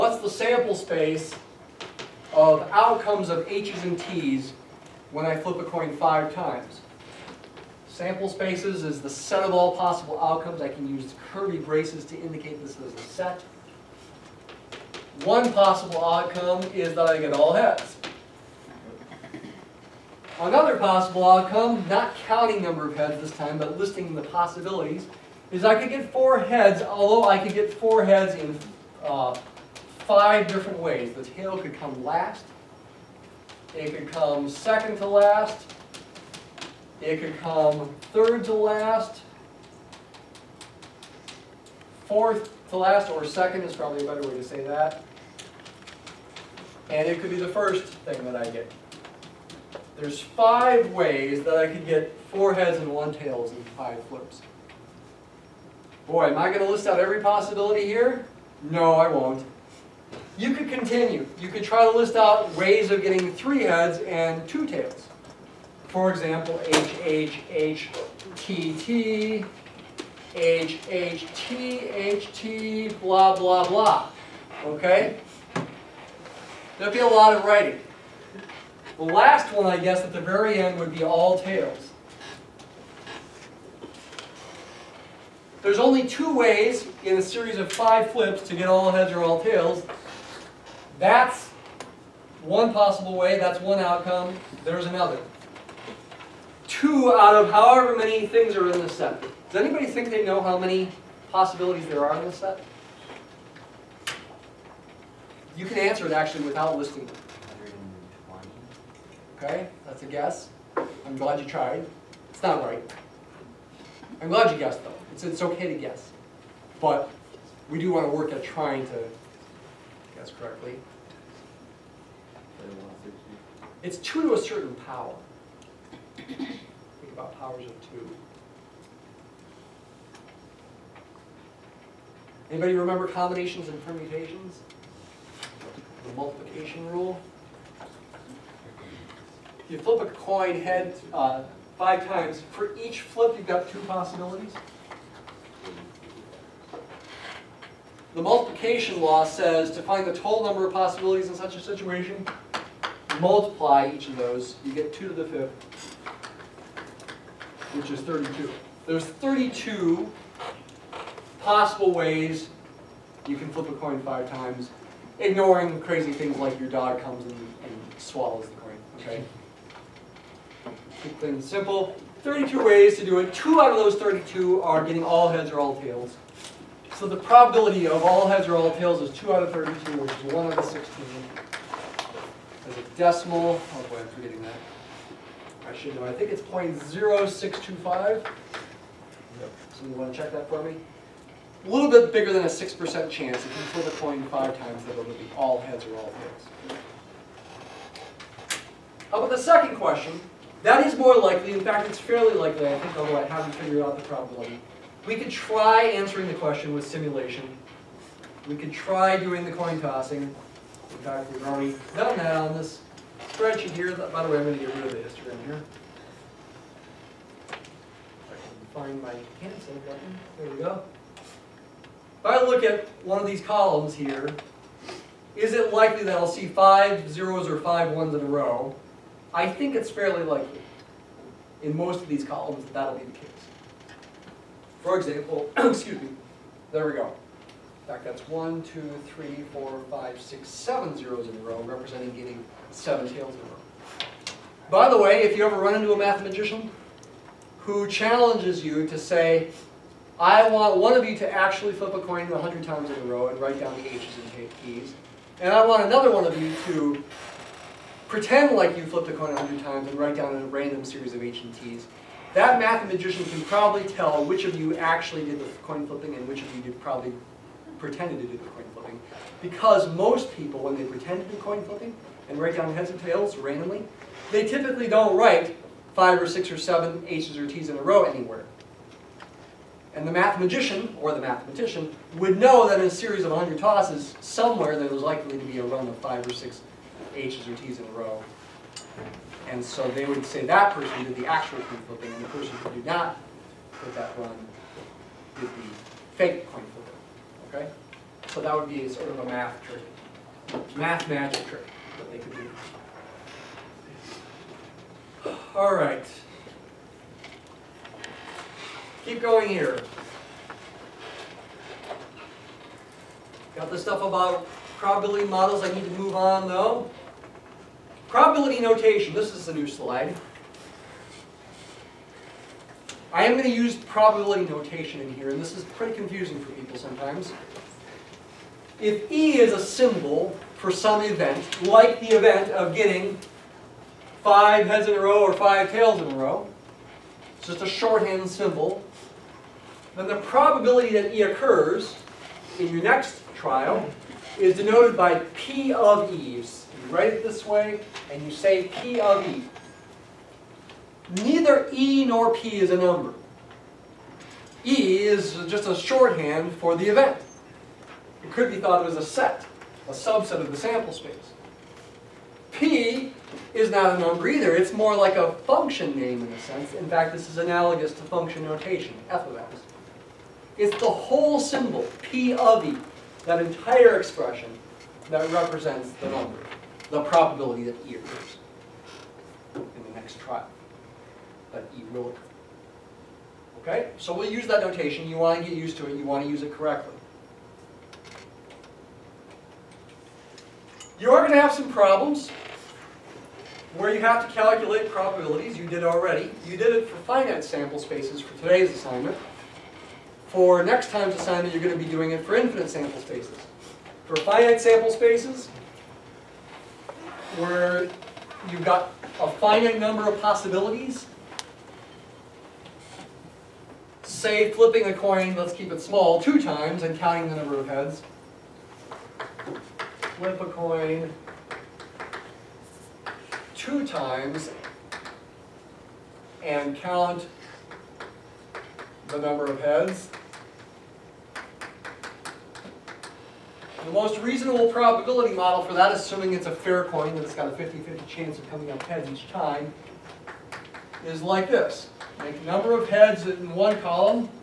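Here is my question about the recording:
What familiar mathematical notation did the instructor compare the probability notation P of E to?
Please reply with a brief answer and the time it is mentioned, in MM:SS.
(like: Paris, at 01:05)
f of x, at 06:09.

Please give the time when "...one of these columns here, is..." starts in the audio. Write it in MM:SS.
03:43.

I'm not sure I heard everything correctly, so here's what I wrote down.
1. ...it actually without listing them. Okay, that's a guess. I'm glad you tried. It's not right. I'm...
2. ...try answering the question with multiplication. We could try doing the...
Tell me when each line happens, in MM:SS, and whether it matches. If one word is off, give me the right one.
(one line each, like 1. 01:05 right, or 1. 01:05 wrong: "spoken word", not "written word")
1. 01:46 right
2. 03:25 wrong: "simulation", not "multiplication".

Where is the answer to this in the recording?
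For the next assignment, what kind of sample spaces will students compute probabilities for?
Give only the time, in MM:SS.
06:42.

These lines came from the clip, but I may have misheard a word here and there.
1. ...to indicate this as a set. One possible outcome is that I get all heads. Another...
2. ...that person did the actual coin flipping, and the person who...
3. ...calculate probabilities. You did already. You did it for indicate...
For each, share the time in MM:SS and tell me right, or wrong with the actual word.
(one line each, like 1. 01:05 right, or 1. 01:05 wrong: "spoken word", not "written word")
1. 00:12 right
2. 04:50 right
3. 06:34 wrong: "finite", not "indicate".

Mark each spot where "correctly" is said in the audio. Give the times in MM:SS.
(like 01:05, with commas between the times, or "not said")
02:00, 06:26.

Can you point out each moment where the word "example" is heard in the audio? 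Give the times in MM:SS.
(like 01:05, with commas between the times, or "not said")
01:06, 03:54.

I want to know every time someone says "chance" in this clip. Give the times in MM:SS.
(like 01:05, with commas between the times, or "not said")
03:13, 07:18.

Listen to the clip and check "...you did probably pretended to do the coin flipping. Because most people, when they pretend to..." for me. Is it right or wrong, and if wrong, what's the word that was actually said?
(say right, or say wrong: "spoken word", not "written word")
right.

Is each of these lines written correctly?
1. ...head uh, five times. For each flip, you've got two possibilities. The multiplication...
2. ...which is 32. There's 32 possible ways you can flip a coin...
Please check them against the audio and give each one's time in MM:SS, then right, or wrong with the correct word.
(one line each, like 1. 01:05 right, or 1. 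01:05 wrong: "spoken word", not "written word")
1. 02:20 right
2. 02:37 right.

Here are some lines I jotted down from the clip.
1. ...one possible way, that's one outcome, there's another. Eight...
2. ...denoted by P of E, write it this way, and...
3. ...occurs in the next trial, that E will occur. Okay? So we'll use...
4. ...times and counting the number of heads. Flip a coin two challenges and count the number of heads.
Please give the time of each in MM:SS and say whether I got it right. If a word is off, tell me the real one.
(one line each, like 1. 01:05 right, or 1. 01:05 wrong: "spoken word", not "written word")
1. 01:32 wrong: "Two", not "Eight"
2. 05:44 right
3. 06:17 right
4. 06:56 wrong: "times", not "challenges".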